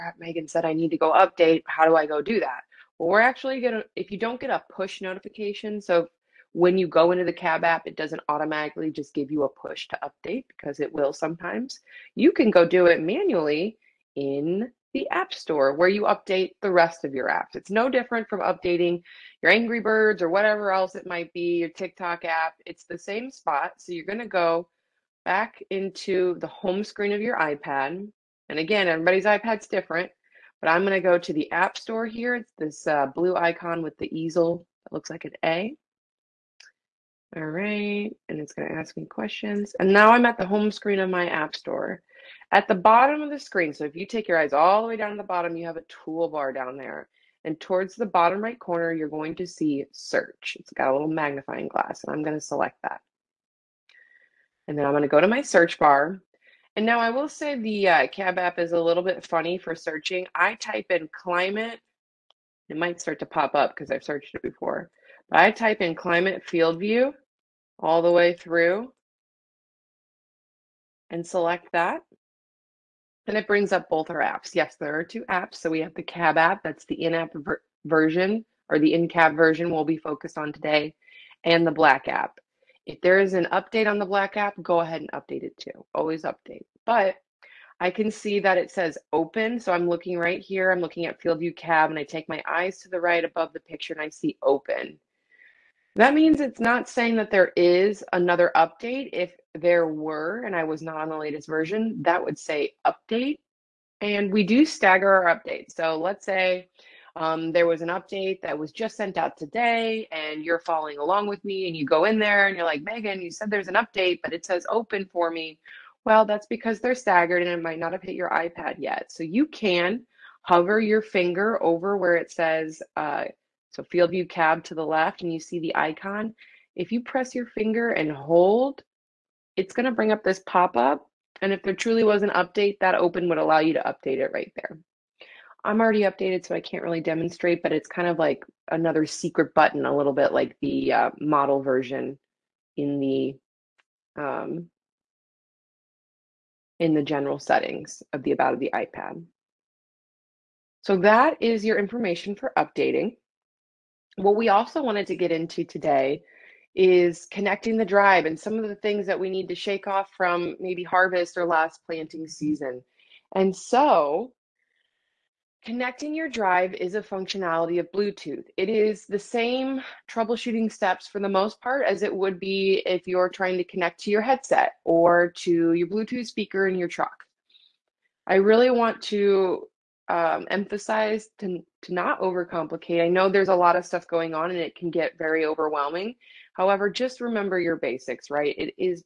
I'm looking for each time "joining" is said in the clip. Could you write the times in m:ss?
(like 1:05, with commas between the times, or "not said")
not said.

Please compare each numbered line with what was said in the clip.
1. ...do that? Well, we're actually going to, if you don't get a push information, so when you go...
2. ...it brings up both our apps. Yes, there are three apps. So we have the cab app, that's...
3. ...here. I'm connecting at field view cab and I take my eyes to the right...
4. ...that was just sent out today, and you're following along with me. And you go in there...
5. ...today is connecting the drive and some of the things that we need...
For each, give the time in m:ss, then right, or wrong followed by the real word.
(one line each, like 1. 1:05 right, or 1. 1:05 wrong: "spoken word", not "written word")
1. 0:02 wrong: "notification", not "information"
2. 1:13 wrong: "two", not "three"
3. 1:30 wrong: "looking", not "connecting"
4. 1:48 right
5. 2:35 right.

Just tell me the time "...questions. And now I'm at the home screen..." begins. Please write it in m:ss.
0:39.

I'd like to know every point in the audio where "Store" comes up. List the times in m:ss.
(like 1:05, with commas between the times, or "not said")
0:15, 0:31, 0:41.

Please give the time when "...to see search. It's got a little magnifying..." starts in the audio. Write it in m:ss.
0:49.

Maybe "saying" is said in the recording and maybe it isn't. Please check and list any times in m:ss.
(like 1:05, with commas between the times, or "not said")
1:36.